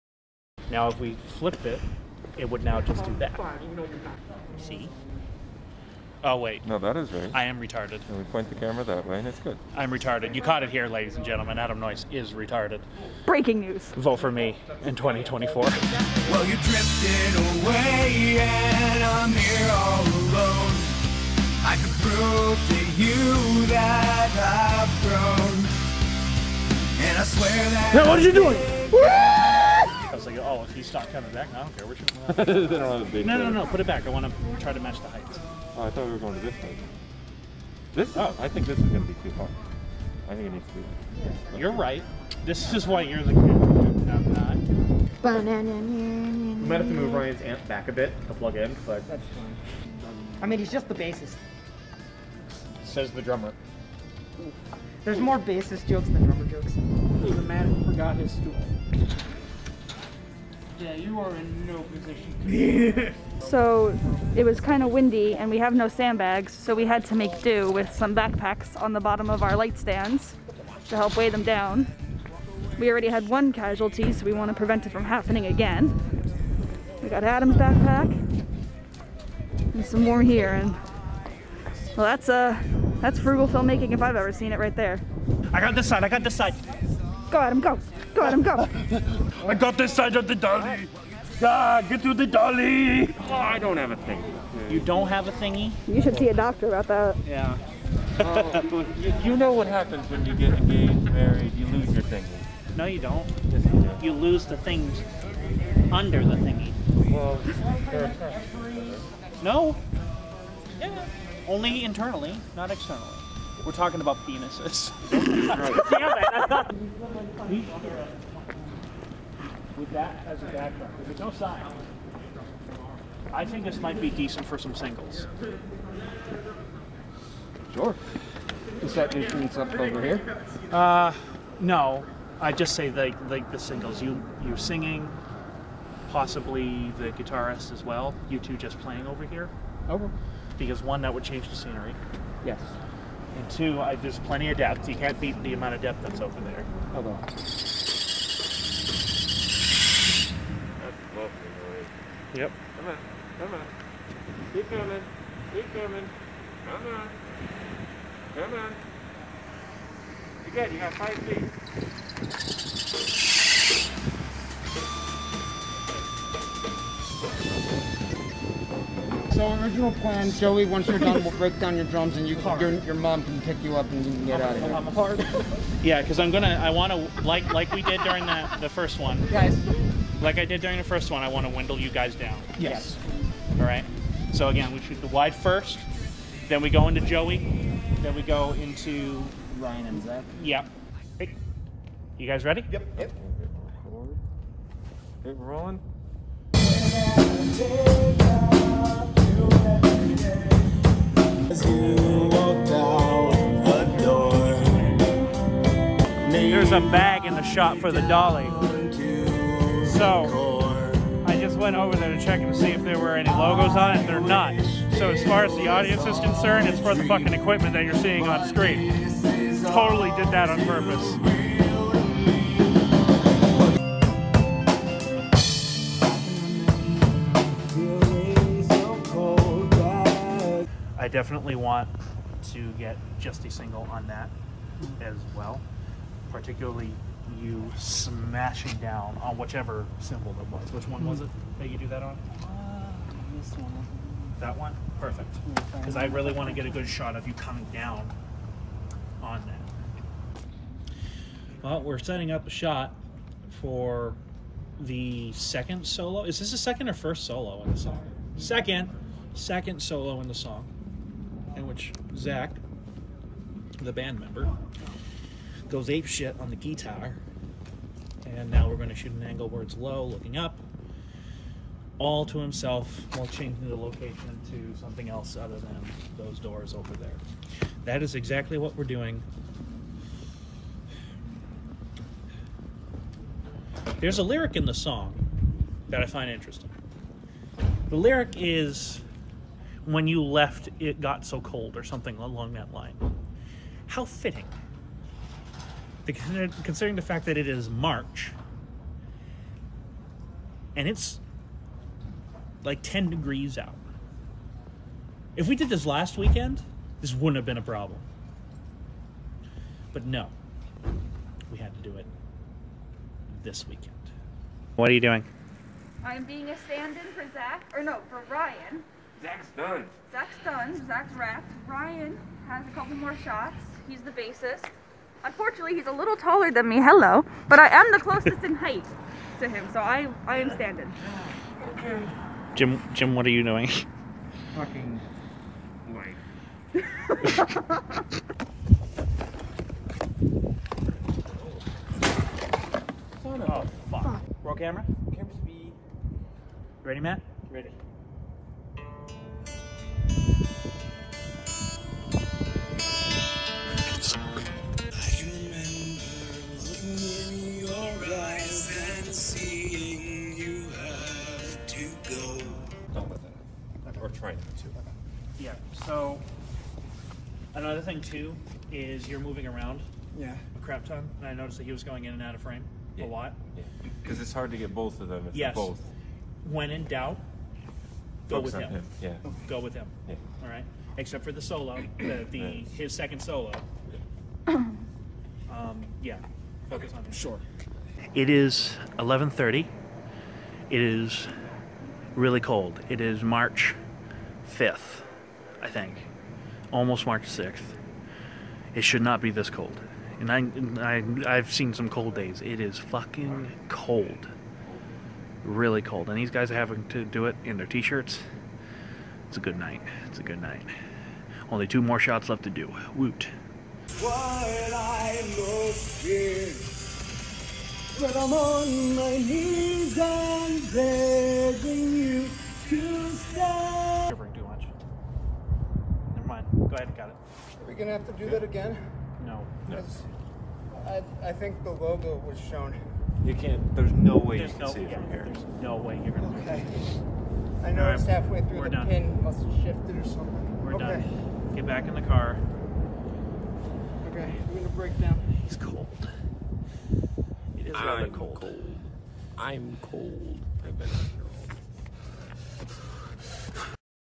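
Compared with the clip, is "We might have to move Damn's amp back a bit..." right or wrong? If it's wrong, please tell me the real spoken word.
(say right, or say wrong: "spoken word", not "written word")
wrong: "Ryan", not "Damn".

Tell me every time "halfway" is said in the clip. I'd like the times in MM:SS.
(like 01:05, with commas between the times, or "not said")
07:18.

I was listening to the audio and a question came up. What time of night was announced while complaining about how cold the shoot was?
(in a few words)
11:30.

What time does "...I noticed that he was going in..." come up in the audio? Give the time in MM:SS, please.
06:11.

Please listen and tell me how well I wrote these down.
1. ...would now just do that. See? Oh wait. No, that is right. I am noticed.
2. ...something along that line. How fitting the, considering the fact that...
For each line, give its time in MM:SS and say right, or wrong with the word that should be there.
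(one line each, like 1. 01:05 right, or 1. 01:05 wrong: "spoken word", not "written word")
1. 00:02 wrong: "retarded", not "noticed"
2. 04:51 right.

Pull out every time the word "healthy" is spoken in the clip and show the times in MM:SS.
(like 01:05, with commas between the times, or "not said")
not said.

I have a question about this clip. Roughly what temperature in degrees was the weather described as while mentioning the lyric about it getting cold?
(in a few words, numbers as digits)
10 degrees.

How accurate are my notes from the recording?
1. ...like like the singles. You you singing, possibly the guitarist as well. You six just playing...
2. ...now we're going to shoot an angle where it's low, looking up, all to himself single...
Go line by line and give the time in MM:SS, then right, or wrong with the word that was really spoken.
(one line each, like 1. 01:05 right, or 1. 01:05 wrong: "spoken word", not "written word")
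1. 02:12 wrong: "two", not "six"
2. 04:28 wrong: "while", not "single".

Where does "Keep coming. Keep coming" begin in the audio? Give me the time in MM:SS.
02:34.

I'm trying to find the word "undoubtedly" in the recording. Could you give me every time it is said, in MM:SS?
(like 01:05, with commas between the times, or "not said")
not said.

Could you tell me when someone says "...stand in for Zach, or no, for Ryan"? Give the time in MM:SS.
05:16.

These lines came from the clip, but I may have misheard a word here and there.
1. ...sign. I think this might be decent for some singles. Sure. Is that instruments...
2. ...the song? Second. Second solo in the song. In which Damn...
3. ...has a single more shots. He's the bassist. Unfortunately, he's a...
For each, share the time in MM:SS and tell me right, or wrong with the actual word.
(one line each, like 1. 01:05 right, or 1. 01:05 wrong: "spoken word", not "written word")
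1. 02:01 right
2. 04:17 wrong: "Zach", not "Damn"
3. 05:22 wrong: "couple", not "single".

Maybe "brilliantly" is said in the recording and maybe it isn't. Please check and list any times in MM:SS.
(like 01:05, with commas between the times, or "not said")
not said.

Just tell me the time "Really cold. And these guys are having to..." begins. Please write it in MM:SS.
06:45.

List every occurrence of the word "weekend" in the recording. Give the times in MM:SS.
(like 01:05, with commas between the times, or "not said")
05:06, 05:13.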